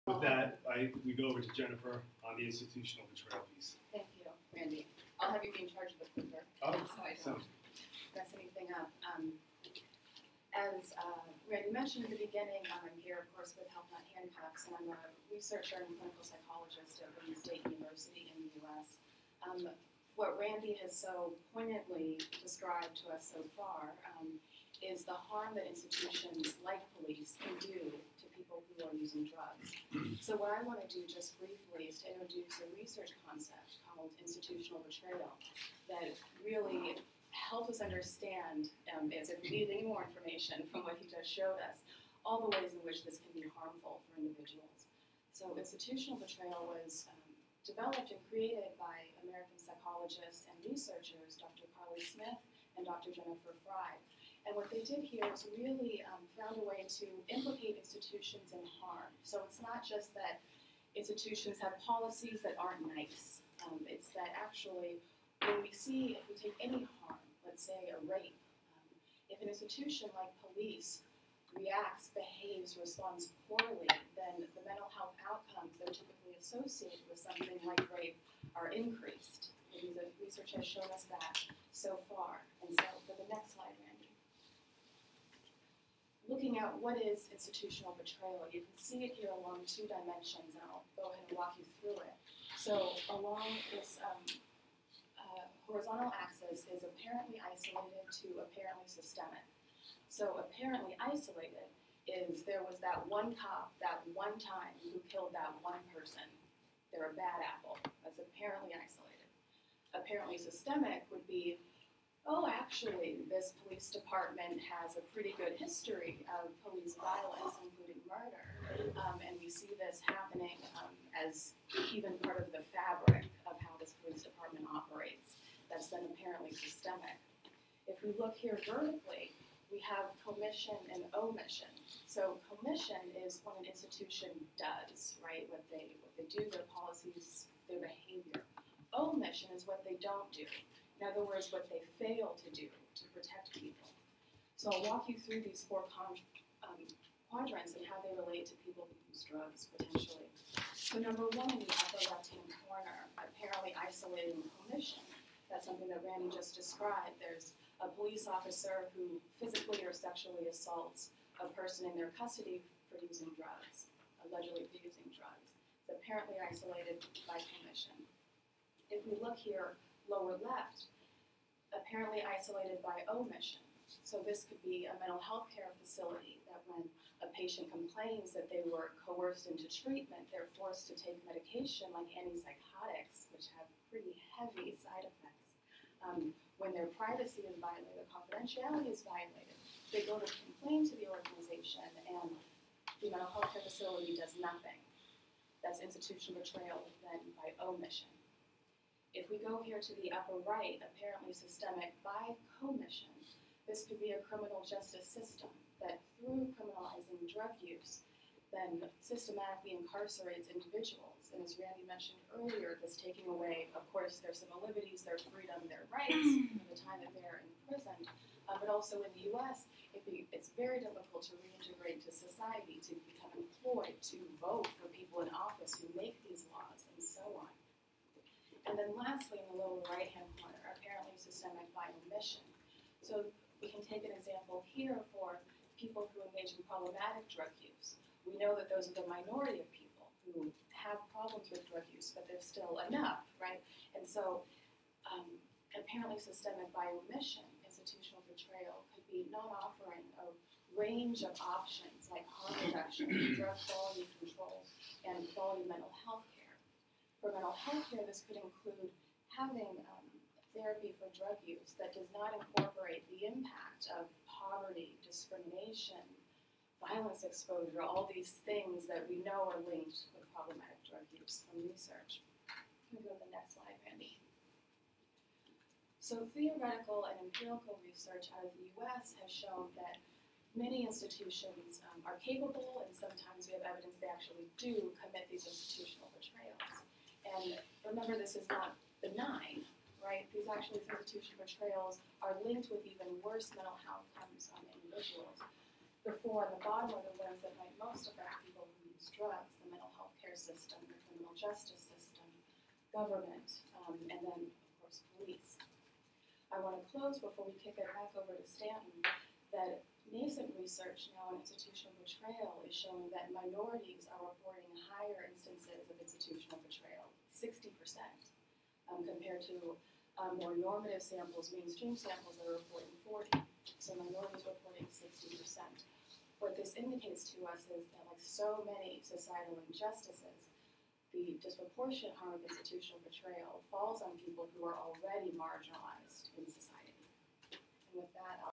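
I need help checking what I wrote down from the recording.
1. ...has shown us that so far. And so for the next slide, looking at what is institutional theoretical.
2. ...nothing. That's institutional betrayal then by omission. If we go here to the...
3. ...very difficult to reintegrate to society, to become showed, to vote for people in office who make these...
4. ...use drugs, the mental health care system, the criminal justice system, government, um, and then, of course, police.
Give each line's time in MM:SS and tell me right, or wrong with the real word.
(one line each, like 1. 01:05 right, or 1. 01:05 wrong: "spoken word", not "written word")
1. 01:20 wrong: "betrayal", not "theoretical"
2. 03:14 right
3. 03:40 wrong: "employed", not "showed"
4. 04:58 right.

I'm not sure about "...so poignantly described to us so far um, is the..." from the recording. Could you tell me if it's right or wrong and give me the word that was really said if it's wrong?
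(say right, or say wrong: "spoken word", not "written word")
right.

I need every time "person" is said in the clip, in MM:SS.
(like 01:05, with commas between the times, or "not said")
01:45, 02:41.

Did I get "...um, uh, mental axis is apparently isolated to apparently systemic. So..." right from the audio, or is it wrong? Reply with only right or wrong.
wrong.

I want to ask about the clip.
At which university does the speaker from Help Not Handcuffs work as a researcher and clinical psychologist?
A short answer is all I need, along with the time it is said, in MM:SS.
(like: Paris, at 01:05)
Wayne State University, at 00:17.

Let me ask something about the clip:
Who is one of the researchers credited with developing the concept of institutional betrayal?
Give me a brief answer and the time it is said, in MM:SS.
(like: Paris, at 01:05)
Dr. Carly Smith, at 00:51.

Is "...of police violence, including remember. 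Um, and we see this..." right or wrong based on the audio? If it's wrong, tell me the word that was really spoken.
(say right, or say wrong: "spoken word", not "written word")
wrong: "murder", not "remember".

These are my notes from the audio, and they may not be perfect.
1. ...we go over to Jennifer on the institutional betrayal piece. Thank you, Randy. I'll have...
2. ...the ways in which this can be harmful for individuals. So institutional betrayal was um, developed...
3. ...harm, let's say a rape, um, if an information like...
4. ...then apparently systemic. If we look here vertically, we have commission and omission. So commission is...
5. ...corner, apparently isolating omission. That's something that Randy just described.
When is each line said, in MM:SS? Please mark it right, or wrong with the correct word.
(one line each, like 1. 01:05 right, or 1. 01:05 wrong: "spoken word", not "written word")
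1. 00:01 right
2. 00:42 right
3. 01:07 wrong: "institution", not "information"
4. 02:05 right
5. 02:32 right.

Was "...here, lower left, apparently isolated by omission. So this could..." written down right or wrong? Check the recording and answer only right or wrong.
right.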